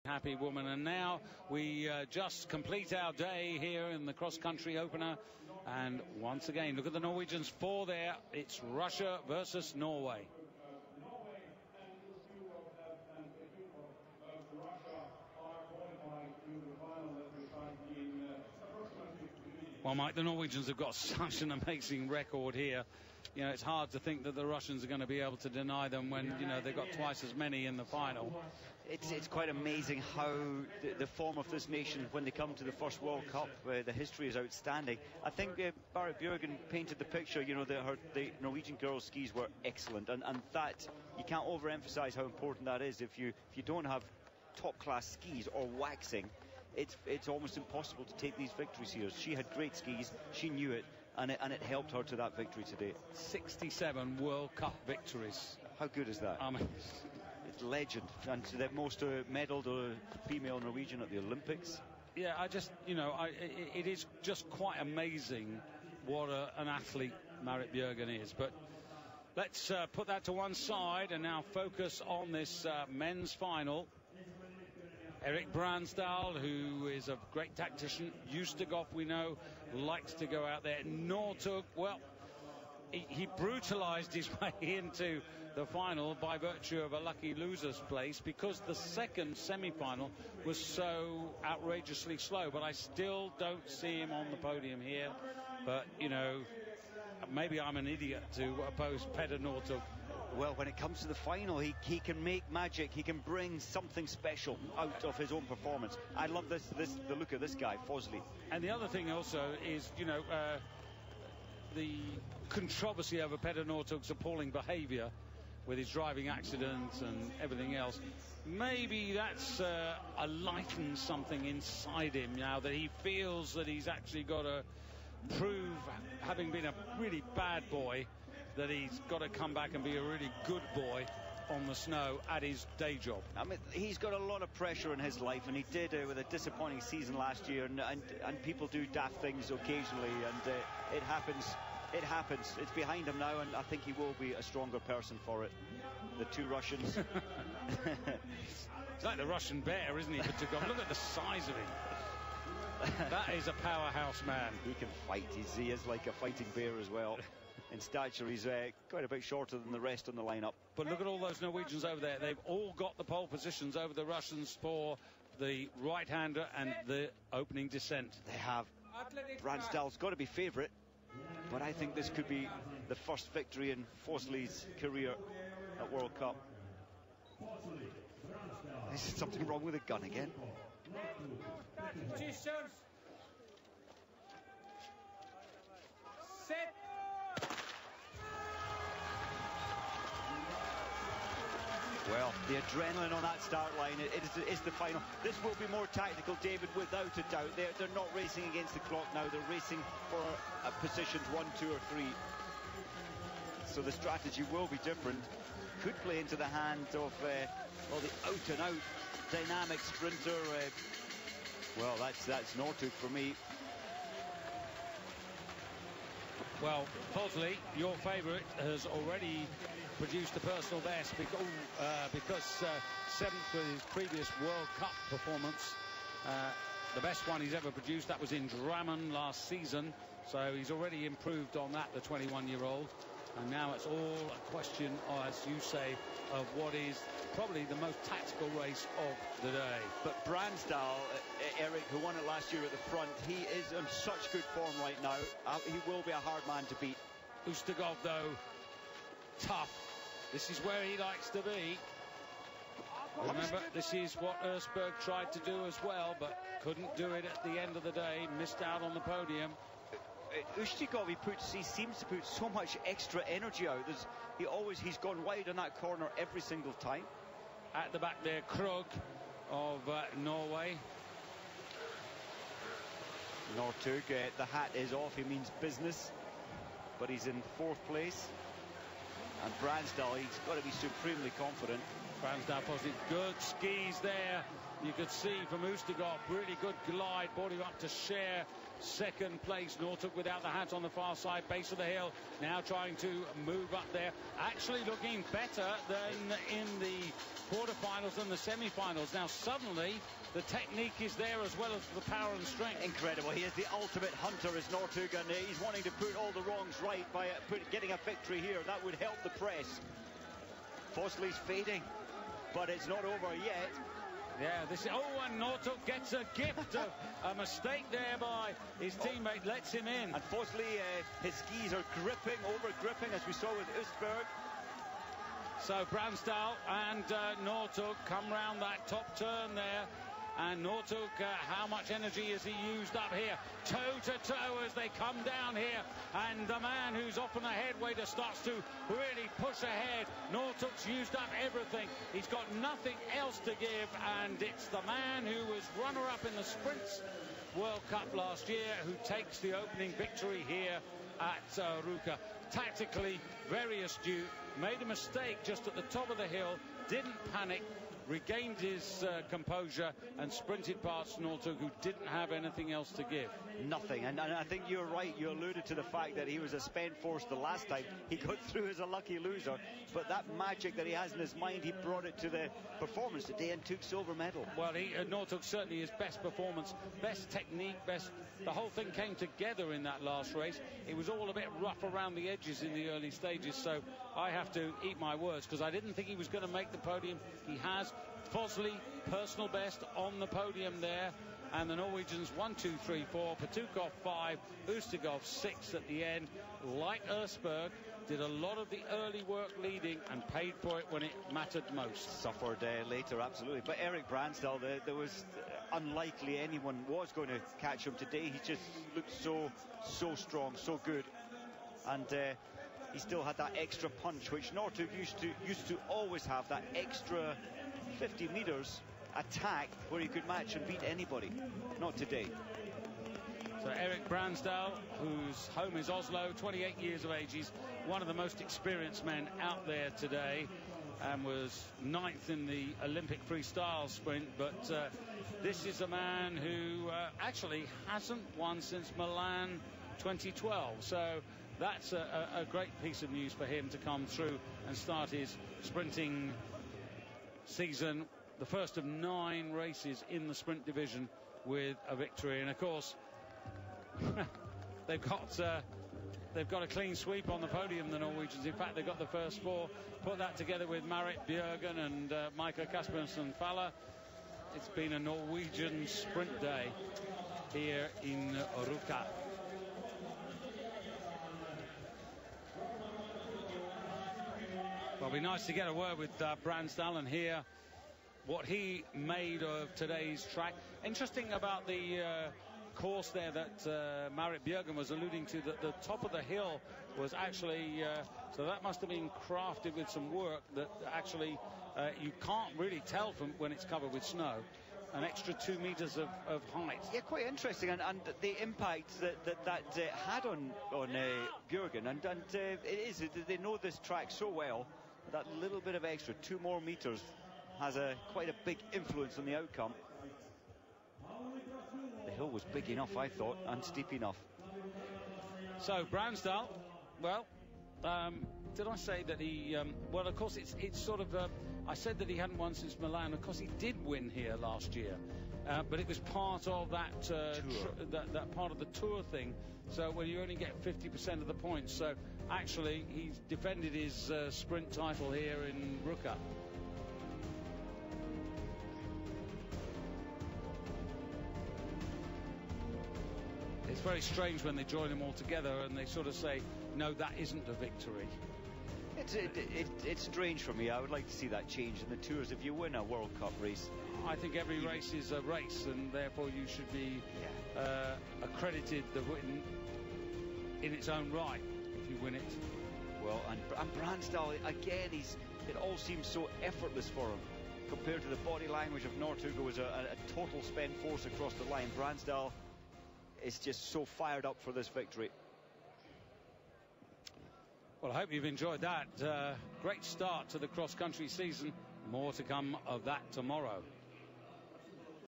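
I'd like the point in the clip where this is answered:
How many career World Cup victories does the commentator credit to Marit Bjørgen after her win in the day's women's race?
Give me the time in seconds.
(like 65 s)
53 s.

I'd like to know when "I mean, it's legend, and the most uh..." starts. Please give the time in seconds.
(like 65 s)
56 s.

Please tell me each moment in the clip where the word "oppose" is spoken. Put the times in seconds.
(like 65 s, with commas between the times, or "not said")
98 s.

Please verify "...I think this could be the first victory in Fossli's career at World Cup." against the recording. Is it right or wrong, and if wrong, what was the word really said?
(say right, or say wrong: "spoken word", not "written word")
right.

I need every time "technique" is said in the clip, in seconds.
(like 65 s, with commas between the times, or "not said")
300 s, 377 s.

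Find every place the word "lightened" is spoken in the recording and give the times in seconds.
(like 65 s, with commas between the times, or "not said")
120 s.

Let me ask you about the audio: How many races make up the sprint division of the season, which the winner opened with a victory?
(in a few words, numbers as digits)
9.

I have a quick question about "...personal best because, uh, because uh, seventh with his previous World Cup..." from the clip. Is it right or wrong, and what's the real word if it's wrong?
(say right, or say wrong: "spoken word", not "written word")
right.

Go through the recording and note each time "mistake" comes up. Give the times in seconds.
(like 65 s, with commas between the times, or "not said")
317 s, 354 s.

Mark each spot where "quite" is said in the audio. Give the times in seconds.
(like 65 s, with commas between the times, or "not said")
29 s, 64 s, 158 s, 496 s, 508 s.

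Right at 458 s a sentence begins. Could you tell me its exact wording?
In fact, they've got the first four.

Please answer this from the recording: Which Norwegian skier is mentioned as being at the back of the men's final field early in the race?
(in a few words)
Krogh.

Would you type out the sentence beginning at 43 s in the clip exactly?
If you, if you don't have top class skis or waxing, it's it's almost impossible to take these victories here.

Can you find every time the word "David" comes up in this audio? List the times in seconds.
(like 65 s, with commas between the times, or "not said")
196 s.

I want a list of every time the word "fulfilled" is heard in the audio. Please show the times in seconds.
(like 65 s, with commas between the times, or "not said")
not said.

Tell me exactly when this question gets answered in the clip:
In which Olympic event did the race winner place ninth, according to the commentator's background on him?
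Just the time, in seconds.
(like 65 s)
432 s.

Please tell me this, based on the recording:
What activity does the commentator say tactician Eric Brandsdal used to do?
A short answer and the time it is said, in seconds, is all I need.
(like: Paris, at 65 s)
Golf, at 78 s.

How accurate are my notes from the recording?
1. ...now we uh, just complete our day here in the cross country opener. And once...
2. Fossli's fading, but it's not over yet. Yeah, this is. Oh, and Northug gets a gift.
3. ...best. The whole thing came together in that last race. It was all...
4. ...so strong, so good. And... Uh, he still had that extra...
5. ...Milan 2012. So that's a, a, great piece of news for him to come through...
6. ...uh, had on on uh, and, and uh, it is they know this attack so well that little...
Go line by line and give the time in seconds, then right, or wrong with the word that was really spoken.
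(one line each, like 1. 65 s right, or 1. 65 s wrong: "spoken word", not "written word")
1. 0 s right
2. 310 s right
3. 377 s right
4. 409 s right
5. 438 s right
6. 499 s wrong: "track", not "attack".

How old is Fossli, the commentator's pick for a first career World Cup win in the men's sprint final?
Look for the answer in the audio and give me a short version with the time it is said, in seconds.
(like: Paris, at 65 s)
21, at 231 s.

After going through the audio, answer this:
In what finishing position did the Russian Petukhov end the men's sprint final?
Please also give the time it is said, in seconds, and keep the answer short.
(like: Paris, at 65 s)
5th, at 393 s.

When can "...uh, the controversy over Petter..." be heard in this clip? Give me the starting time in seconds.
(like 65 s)
110 s.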